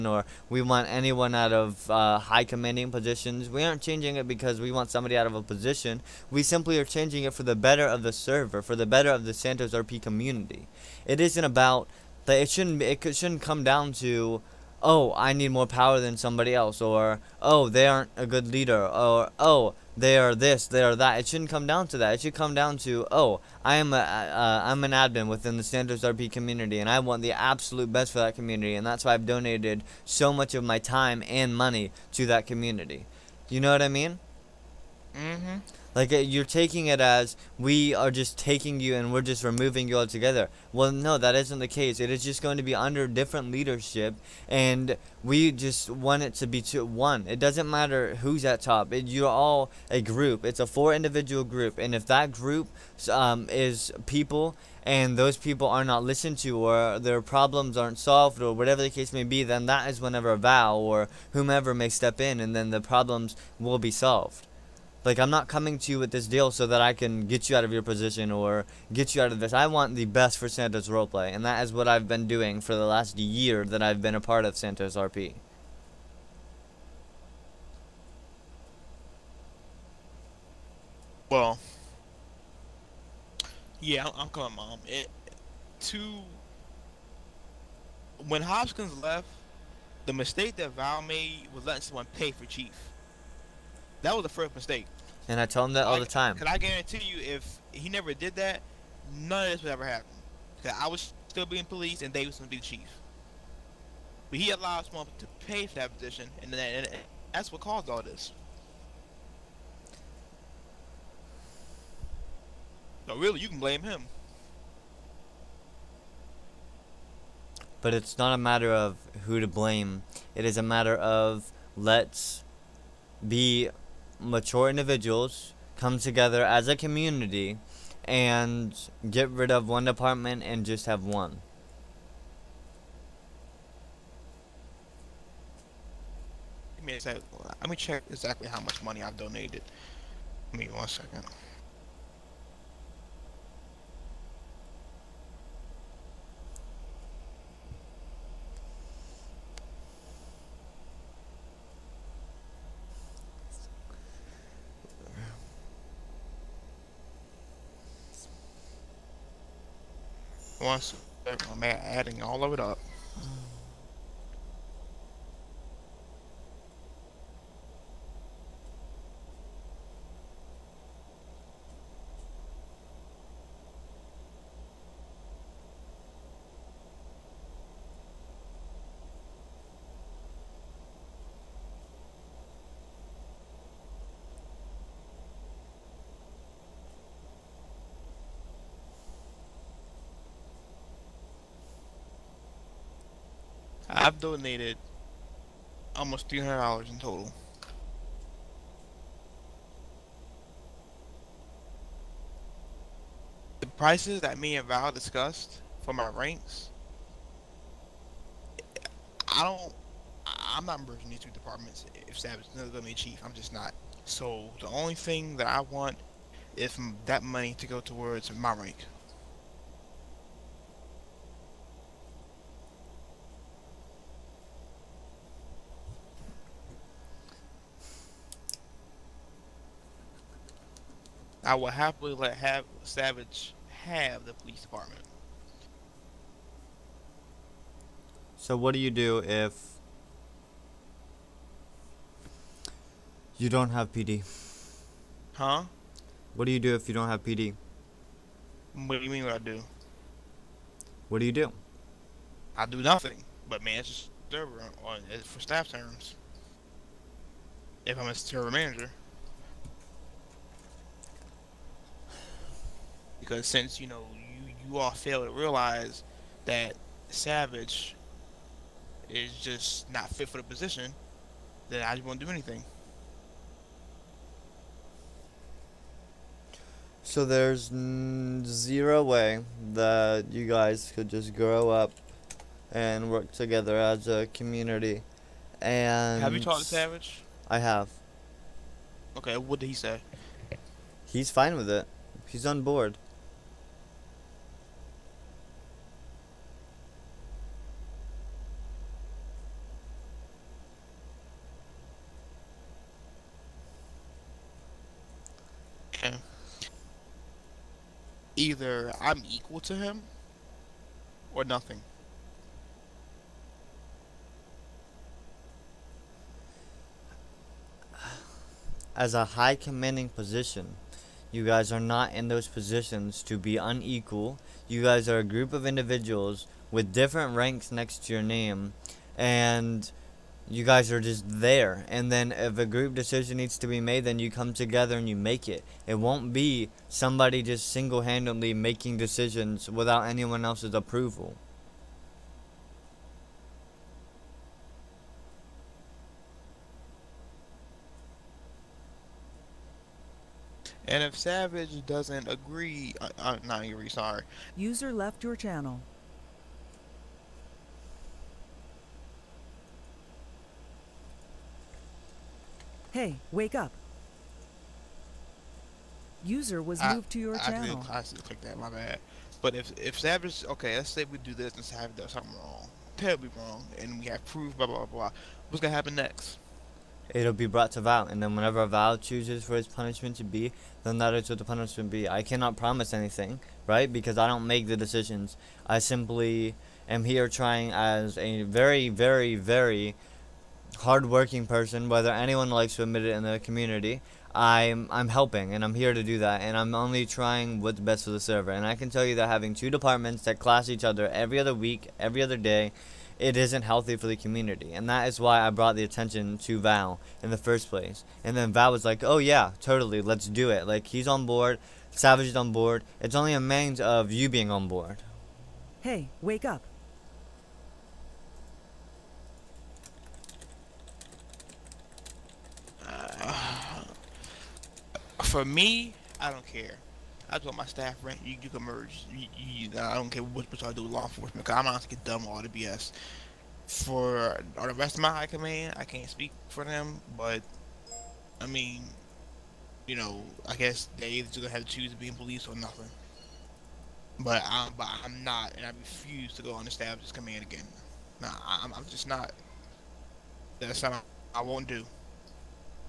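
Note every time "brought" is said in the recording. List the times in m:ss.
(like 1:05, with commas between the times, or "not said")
6:17, 6:45.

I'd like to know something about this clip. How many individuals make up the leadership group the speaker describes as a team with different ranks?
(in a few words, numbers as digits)
4.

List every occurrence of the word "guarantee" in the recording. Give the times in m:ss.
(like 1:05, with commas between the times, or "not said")
1:36.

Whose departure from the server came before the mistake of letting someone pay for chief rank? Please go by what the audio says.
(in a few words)
Hopkins.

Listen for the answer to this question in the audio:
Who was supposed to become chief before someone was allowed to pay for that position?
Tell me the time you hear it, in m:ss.
1:42.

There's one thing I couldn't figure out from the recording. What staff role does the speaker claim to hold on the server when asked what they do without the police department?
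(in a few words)
server manager.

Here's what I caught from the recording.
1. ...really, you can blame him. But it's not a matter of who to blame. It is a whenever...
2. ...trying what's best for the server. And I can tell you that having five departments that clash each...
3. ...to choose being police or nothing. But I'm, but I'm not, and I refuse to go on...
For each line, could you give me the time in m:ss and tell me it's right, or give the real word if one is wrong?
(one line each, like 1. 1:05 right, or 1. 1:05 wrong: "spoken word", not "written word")
1. 1:53 wrong: "matter", not "whenever"
2. 6:37 wrong: "two", not "five"
3. 7:21 right.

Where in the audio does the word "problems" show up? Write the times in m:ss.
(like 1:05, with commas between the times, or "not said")
0:57, 1:02.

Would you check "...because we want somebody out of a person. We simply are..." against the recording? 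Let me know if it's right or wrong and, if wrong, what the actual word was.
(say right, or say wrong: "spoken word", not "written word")
wrong: "position", not "person".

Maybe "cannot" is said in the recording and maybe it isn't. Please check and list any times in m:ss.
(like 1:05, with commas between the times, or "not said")
6:22.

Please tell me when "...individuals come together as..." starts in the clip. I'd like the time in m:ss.
2:04.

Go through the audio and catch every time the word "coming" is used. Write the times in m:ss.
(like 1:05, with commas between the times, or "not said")
1:05, 1:24.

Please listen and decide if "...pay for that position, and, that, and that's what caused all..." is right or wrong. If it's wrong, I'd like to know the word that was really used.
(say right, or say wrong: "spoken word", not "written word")
right.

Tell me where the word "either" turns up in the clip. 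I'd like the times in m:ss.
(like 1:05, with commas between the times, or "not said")
5:08, 7:21.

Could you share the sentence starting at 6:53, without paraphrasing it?
It's only a matter of you being on board.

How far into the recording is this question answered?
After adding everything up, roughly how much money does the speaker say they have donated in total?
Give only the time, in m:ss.
3:15.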